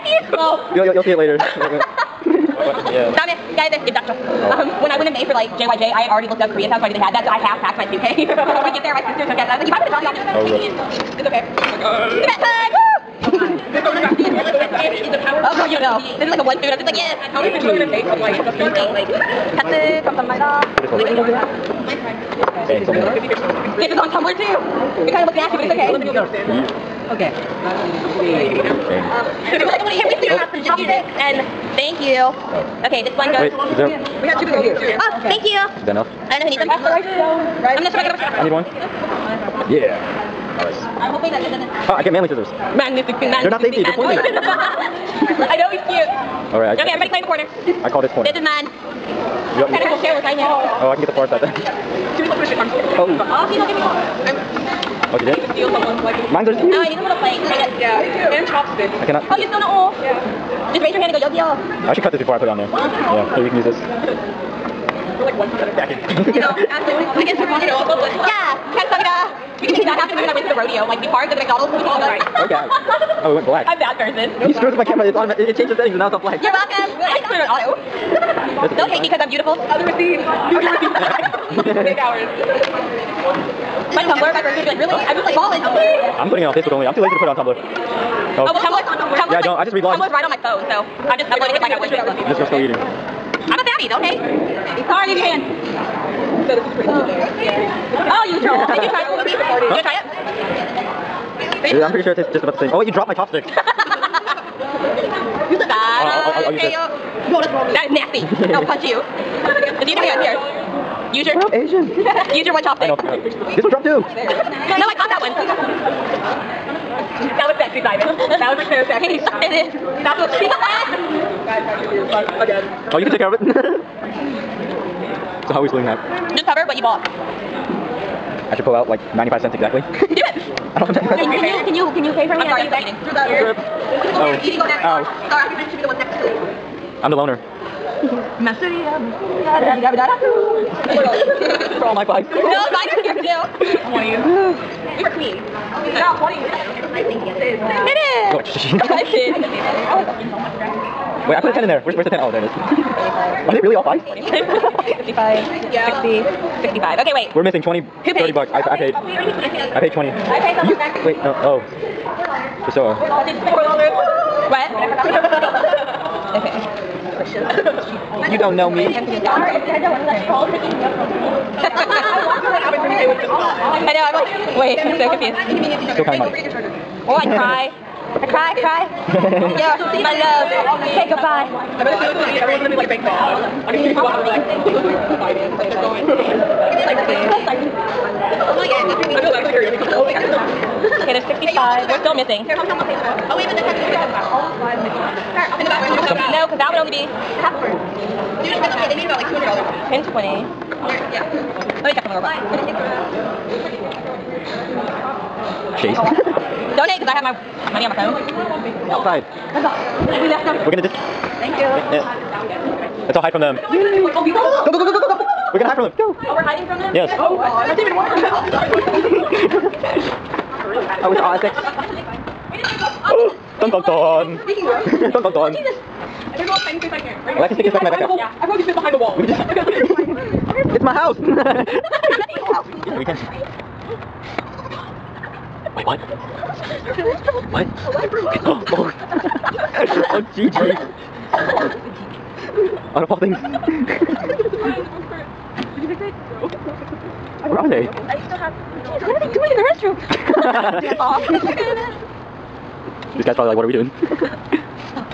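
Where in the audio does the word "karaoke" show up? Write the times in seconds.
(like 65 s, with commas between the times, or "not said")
189 s.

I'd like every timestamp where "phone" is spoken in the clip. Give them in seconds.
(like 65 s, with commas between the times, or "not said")
90 s, 207 s.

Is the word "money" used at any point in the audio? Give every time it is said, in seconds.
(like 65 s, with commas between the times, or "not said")
176 s, 207 s.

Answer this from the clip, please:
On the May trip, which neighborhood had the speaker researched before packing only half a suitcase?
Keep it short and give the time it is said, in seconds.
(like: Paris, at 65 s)
Koreatown, at 6 s.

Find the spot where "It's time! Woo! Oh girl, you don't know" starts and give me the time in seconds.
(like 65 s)
13 s.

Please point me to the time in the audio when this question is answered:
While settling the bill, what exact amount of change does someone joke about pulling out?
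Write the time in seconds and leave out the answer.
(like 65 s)
129 s.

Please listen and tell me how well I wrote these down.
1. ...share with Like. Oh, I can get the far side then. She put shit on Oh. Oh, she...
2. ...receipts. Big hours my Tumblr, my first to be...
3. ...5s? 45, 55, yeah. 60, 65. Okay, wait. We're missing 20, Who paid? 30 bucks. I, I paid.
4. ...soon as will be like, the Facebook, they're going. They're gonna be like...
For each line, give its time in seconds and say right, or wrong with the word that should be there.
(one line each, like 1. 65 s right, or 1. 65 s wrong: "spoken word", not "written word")
1. 50 s wrong: "Simon", not "Like"
2. 81 s right
3. 153 s right
4. 183 s wrong: "Like", not "Facebook".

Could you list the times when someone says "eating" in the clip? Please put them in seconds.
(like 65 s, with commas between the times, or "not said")
92 s, 132 s.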